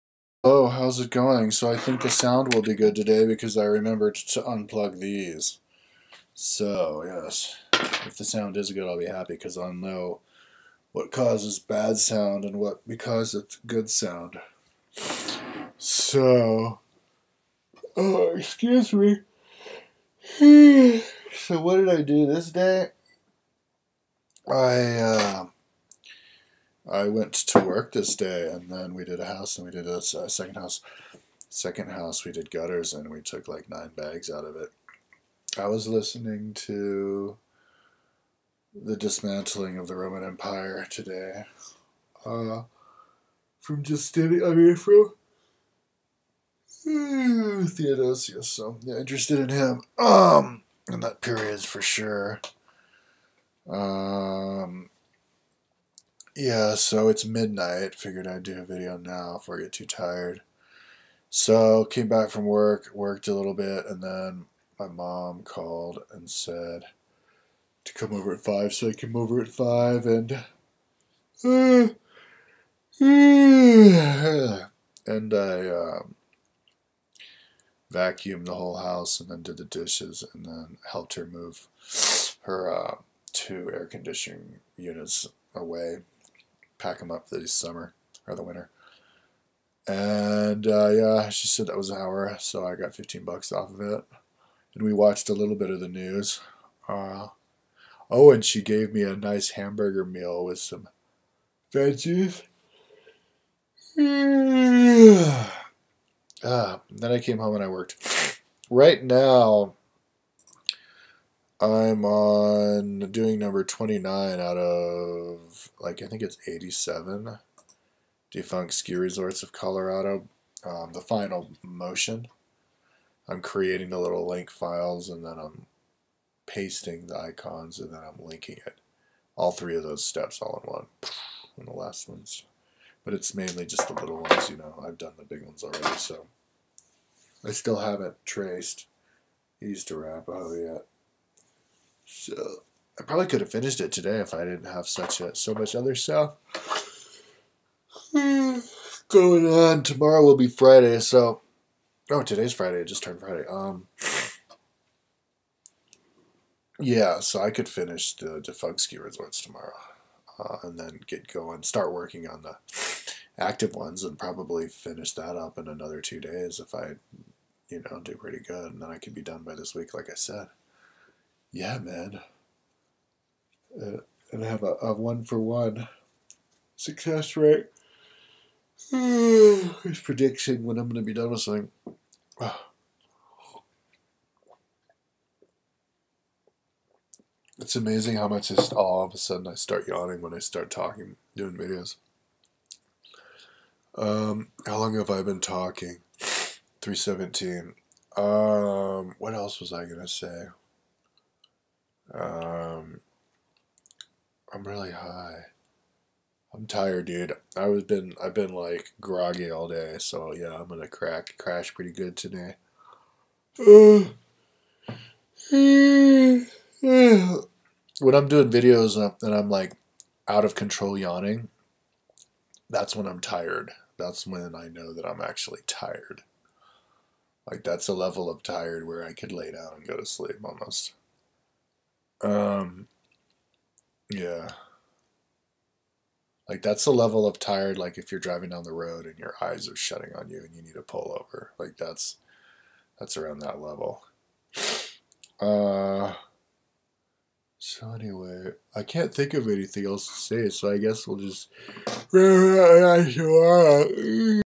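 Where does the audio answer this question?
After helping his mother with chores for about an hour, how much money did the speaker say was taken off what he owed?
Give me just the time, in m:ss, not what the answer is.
1:32.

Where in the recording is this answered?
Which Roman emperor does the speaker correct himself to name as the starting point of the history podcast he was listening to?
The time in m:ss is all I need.
0:47.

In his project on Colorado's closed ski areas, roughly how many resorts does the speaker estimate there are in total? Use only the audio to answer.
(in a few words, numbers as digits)
87.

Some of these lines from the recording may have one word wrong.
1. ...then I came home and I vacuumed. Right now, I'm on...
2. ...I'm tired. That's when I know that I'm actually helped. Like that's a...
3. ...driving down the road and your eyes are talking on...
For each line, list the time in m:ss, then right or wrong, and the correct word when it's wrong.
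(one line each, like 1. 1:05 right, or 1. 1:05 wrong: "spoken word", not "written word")
1. 1:46 wrong: "worked", not "vacuumed"
2. 3:43 wrong: "tired", not "helped"
3. 3:58 wrong: "shutting", not "talking".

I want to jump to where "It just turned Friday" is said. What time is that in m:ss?
2:32.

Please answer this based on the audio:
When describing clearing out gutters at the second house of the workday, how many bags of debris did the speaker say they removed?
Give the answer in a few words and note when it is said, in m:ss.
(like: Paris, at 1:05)
9, at 0:33.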